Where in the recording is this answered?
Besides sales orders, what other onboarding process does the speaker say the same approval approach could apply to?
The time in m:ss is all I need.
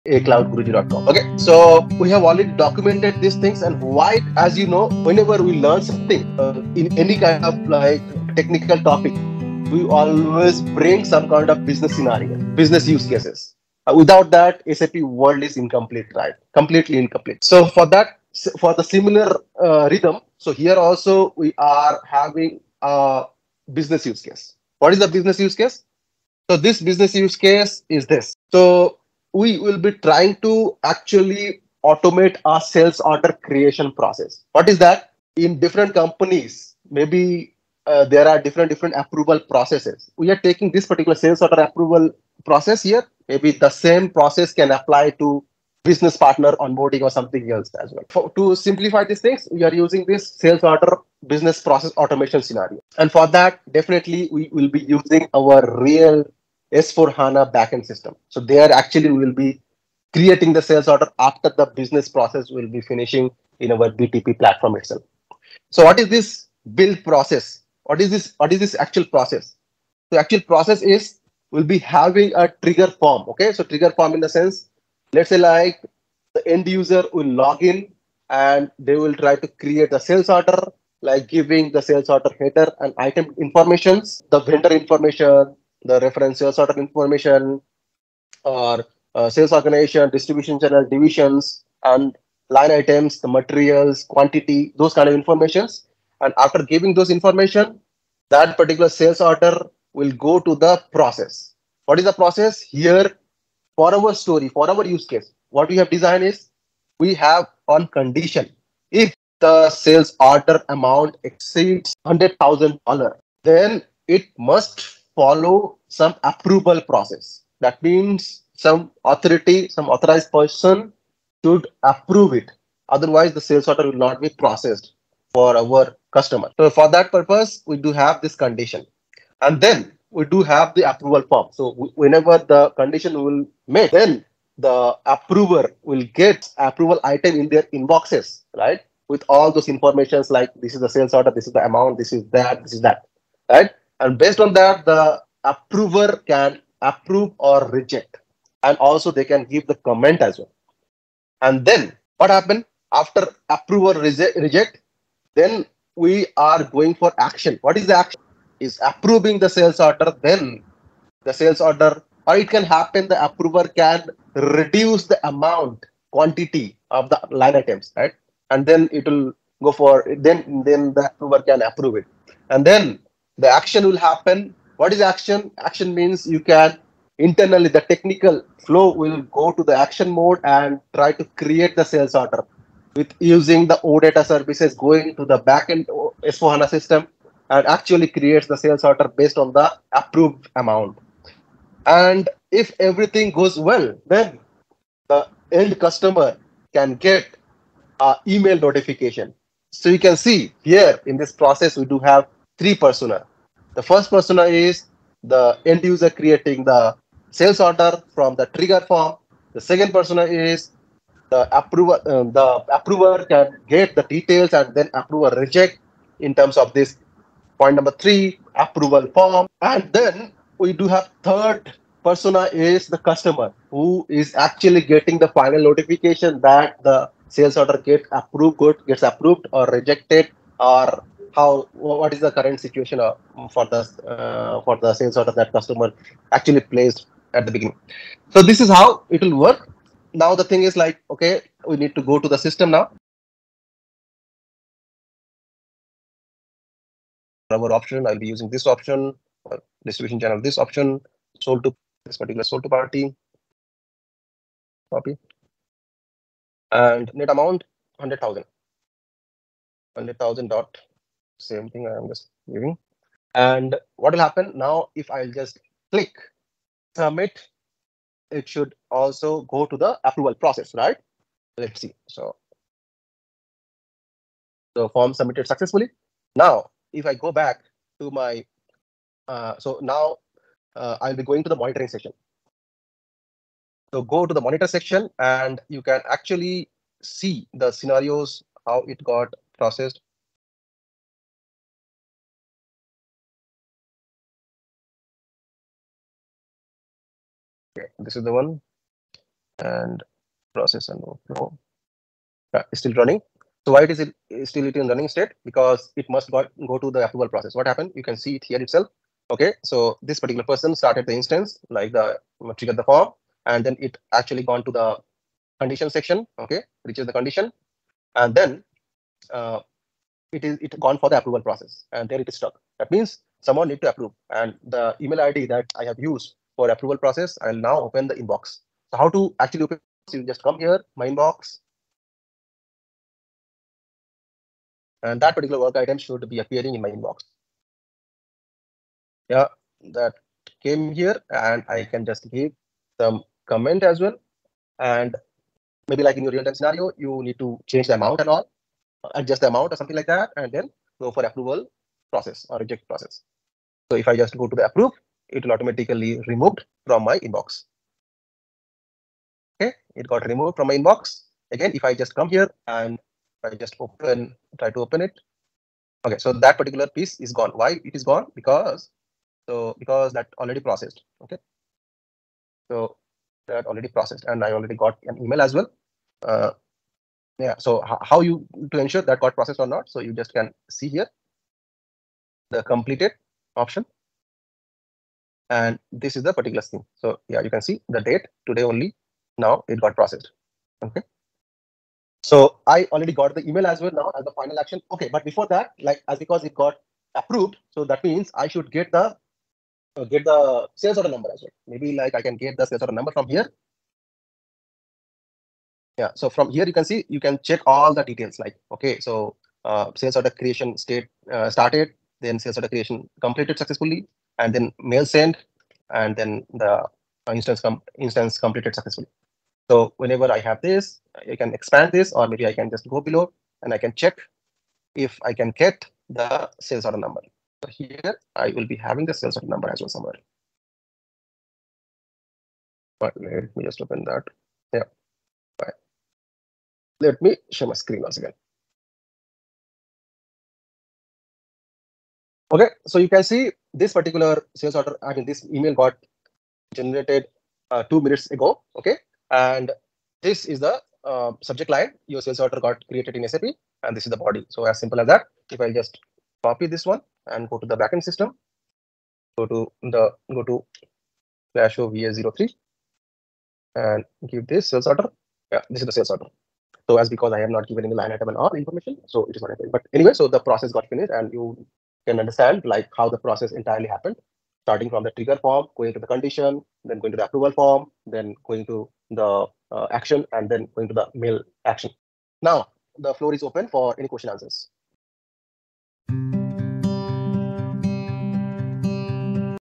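0:45.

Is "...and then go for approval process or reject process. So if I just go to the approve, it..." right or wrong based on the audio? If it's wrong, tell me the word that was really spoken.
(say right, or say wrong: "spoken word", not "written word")
right.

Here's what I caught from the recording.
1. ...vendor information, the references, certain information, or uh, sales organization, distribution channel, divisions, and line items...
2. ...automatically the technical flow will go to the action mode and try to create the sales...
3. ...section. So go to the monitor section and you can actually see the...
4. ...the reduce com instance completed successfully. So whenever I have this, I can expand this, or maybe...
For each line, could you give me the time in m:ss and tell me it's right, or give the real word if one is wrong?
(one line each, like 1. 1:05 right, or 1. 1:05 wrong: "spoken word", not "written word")
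1. 1:24 right
2. 2:57 wrong: "internally", not "automatically"
3. 4:41 right
4. 6:56 wrong: "instance", not "reduce".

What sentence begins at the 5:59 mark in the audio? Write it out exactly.
Okay, it got removed from my inbox.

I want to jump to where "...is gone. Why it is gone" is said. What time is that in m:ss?
6:07.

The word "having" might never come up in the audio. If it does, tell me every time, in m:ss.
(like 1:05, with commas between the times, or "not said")
0:22, 1:11, 7:08.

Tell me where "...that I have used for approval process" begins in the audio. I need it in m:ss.
5:25.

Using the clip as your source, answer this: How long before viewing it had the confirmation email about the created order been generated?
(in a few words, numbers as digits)
Two minutes.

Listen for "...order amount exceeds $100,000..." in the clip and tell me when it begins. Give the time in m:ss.
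1:50.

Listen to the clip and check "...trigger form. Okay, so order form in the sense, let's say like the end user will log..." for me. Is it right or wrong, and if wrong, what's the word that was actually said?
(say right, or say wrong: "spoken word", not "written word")
wrong: "trigger", not "order".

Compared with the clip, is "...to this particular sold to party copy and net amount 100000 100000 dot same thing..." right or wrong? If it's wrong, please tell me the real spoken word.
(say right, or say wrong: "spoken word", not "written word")
right.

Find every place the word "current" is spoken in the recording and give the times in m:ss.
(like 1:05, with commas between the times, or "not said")
3:52.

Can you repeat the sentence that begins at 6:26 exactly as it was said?
So yeah, you can see the date today only.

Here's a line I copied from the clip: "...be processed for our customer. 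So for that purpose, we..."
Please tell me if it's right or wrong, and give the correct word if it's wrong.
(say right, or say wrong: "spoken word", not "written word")
right.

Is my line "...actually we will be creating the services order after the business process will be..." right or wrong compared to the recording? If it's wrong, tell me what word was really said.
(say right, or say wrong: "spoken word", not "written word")
wrong: "sales", not "services".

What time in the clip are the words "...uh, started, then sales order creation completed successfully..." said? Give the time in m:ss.
6:51.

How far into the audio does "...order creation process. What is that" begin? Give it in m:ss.
0:32.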